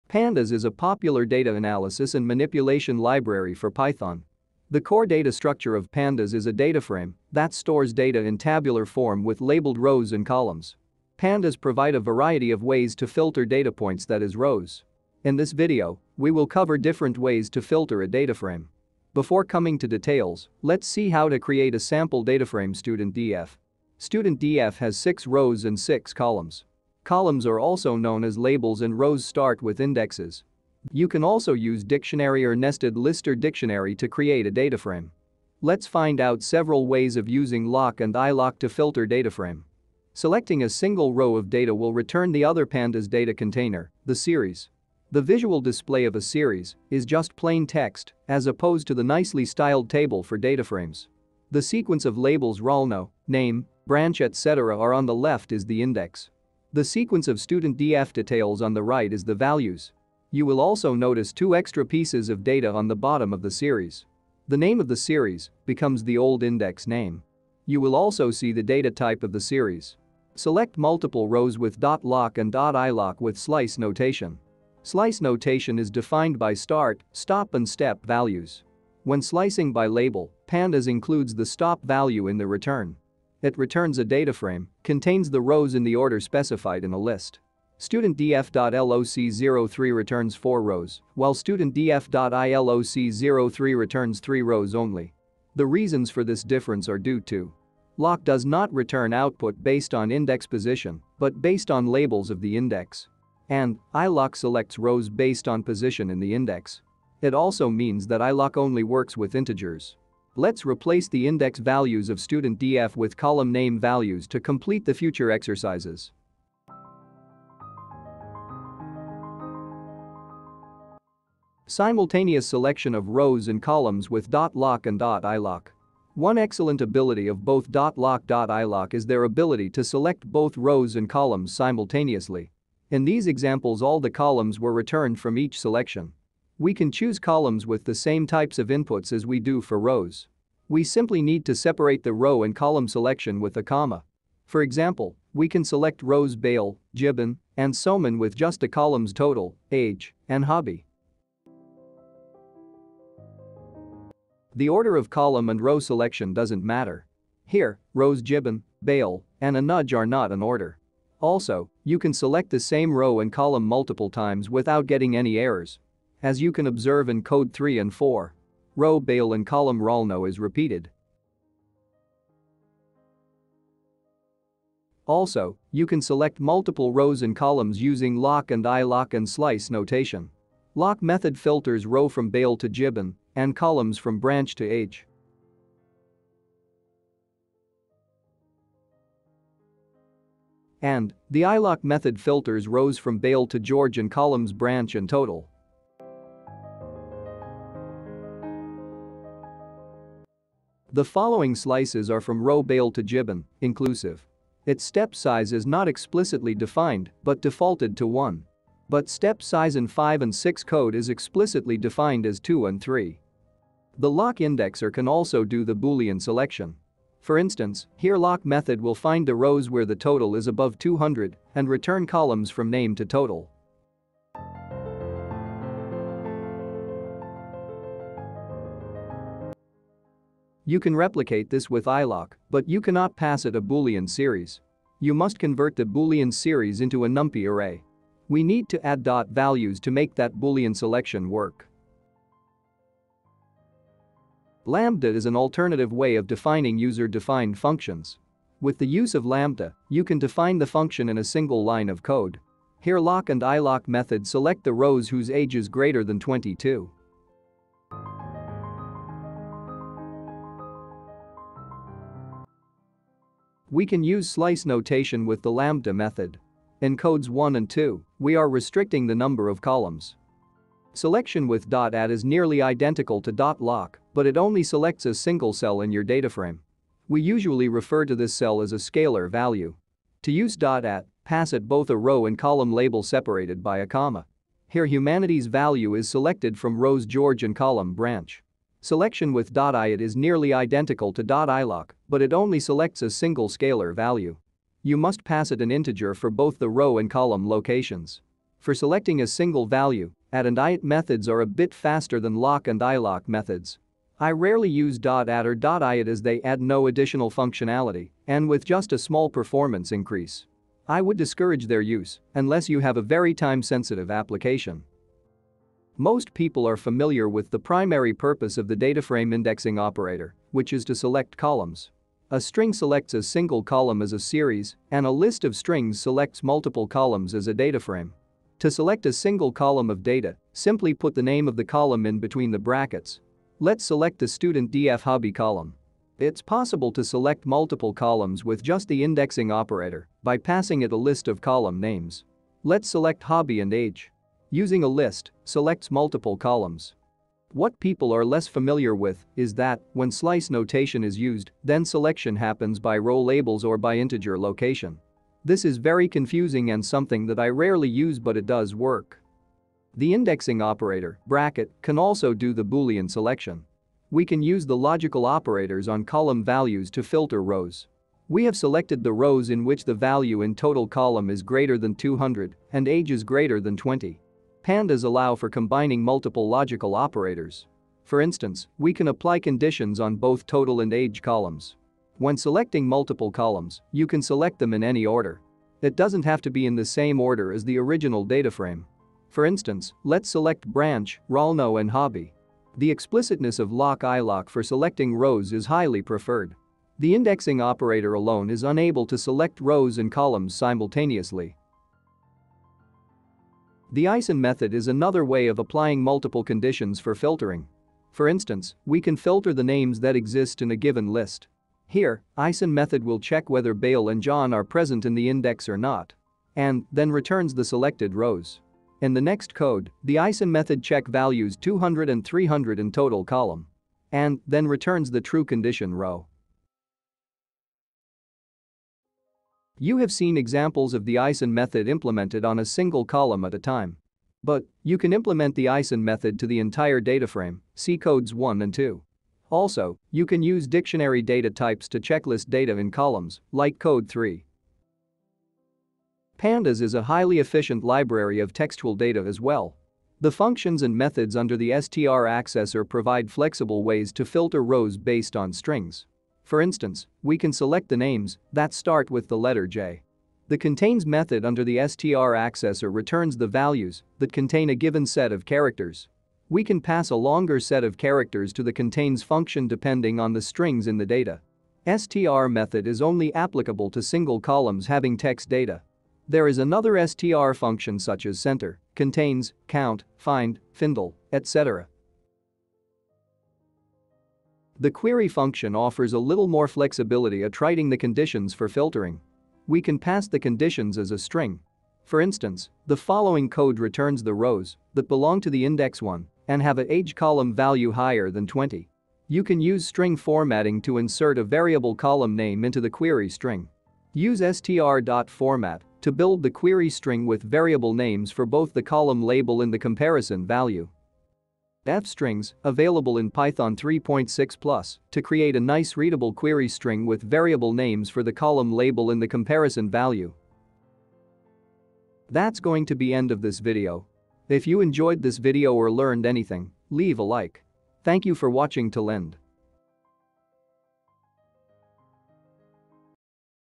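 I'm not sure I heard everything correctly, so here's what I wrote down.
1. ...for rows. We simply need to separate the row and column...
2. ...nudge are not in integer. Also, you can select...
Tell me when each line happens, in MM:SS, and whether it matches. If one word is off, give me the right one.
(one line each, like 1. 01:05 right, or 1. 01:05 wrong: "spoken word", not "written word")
1. 02:19 right
2. 02:39 wrong: "order", not "integer".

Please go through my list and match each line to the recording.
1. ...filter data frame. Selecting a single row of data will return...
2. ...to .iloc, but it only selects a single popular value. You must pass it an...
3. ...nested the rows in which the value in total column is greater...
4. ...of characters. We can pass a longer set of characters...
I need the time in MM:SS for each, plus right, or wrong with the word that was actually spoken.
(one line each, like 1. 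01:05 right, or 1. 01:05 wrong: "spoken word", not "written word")
1. 00:38 right
2. 04:51 wrong: "scalar", not "popular"
3. 06:08 wrong: "selected", not "nested"
4. 07:45 right.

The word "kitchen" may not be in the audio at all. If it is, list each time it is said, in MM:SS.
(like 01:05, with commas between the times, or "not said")
not said.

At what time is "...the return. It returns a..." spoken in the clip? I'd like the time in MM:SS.
01:22.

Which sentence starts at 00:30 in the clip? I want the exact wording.
You can also use dictionary or nested list or dictionary to create a data frame.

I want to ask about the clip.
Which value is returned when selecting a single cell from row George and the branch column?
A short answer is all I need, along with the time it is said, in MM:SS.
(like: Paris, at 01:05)
Humanities, at 04:44.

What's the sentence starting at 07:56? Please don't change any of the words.
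There is another str function such as center, contains, count, find, findall, etc.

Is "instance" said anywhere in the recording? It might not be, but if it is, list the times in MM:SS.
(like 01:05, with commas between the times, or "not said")
03:37, 06:18, 06:29, 06:48, 07:36, 08:12.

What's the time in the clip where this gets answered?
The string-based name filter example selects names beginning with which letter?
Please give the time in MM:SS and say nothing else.
07:39.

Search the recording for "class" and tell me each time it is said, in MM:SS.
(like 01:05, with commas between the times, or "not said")
not said.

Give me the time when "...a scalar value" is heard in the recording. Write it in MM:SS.
04:38.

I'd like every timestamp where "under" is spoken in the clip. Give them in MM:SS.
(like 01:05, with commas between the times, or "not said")
07:31, 07:41.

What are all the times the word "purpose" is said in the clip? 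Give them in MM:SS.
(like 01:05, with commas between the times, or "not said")
05:18.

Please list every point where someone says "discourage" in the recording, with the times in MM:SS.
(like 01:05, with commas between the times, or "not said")
05:11.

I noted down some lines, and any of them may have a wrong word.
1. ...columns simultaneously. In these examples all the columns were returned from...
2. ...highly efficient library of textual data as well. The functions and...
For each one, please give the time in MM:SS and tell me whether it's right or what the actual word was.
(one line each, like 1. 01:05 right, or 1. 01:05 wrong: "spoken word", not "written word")
1. 02:11 right
2. 07:27 right.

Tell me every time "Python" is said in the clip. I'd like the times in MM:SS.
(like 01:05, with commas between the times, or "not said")
00:03, 08:33.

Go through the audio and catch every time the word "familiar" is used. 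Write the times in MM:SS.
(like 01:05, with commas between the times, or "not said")
05:16, 05:48.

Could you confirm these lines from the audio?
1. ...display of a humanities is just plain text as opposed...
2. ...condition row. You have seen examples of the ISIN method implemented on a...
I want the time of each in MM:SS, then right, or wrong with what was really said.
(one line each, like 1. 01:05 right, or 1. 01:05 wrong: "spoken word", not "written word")
1. 00:45 wrong: "series", not "humanities"
2. 07:05 right.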